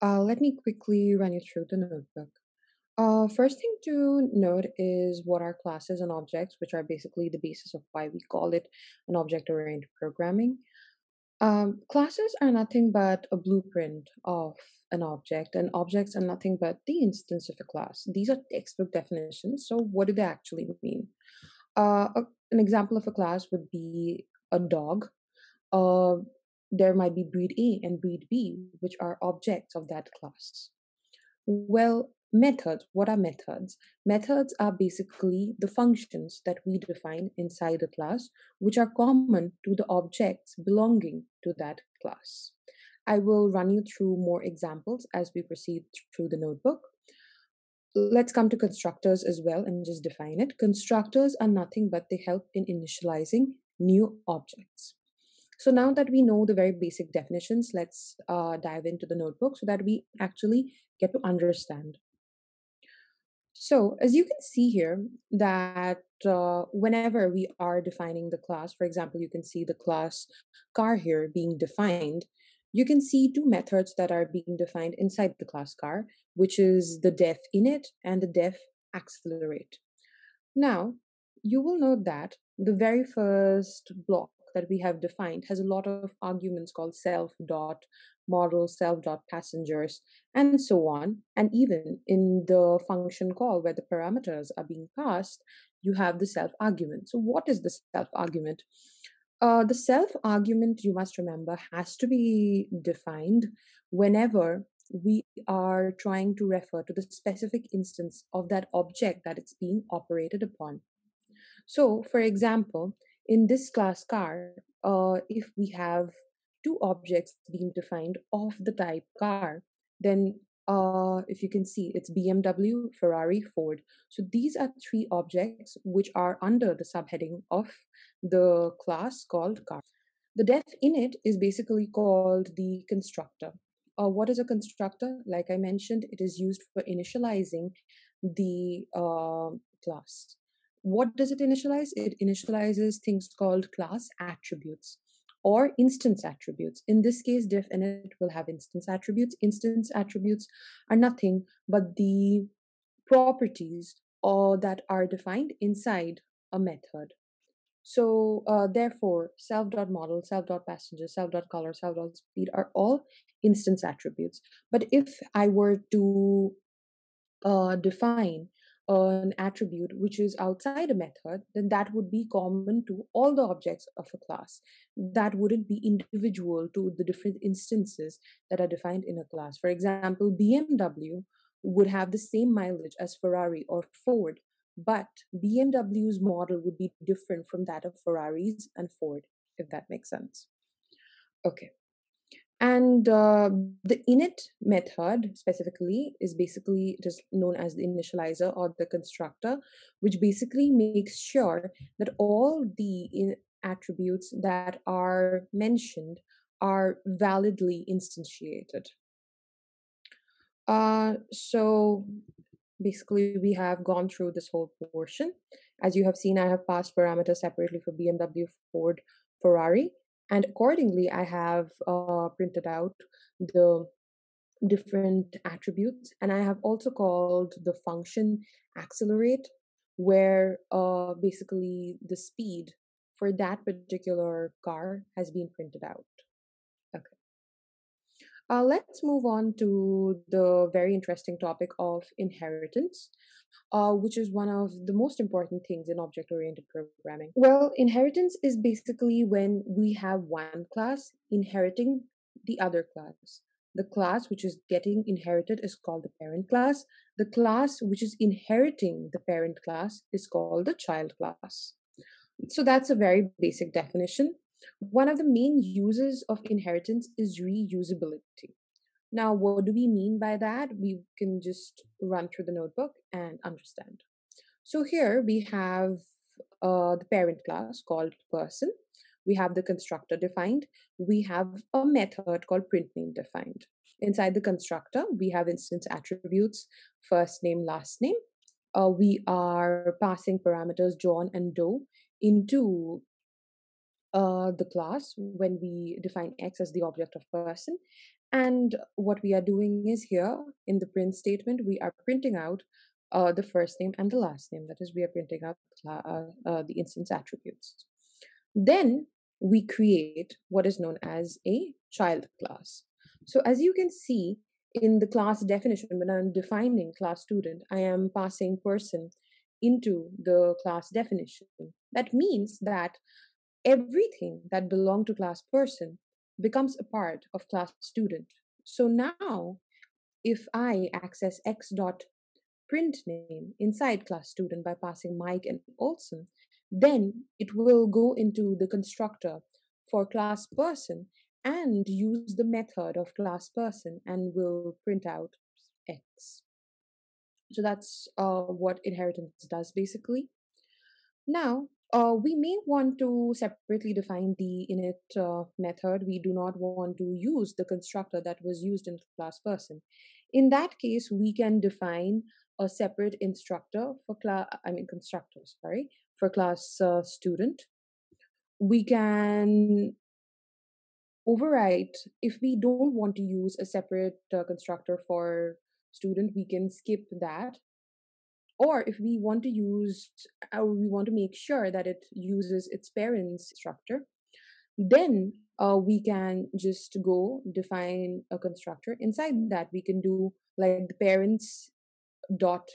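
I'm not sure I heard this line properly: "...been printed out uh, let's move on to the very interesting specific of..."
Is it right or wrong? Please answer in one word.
wrong.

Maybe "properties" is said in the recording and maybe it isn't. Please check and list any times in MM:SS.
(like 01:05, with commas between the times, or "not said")
02:33.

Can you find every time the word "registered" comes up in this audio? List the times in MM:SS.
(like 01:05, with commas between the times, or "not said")
not said.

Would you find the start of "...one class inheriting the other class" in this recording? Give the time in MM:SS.
04:10.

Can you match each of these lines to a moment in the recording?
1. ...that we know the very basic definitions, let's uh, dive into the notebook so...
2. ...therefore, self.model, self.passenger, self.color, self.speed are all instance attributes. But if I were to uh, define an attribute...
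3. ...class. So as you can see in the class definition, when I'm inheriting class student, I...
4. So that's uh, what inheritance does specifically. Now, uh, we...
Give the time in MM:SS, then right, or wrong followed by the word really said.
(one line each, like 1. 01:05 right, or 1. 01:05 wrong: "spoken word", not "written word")
1. 00:55 right
2. 02:38 right
3. 05:12 wrong: "defining", not "inheriting"
4. 05:47 wrong: "basically", not "specifically".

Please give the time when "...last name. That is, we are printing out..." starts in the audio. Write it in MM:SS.
05:04.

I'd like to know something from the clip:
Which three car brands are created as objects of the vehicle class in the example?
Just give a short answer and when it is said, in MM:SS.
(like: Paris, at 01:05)
BMW, Ferrari, Ford, at 02:02.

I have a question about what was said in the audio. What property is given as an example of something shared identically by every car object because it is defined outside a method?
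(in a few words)
mileage.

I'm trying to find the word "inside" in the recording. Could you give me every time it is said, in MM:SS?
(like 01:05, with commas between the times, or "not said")
00:37, 01:14, 02:35, 04:43, 05:33, 06:28.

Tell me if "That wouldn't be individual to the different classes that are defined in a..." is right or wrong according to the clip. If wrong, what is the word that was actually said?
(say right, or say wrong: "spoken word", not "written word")
wrong: "instances", not "classes".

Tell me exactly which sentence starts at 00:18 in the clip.
These are textbook definitions, so what do they actually mean?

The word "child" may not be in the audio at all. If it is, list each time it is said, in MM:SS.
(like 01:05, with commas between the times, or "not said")
04:20, 05:11.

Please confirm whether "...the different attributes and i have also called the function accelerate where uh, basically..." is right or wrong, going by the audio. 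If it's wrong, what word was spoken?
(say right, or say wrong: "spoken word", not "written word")
right.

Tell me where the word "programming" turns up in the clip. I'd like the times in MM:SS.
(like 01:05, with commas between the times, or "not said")
00:10, 04:06.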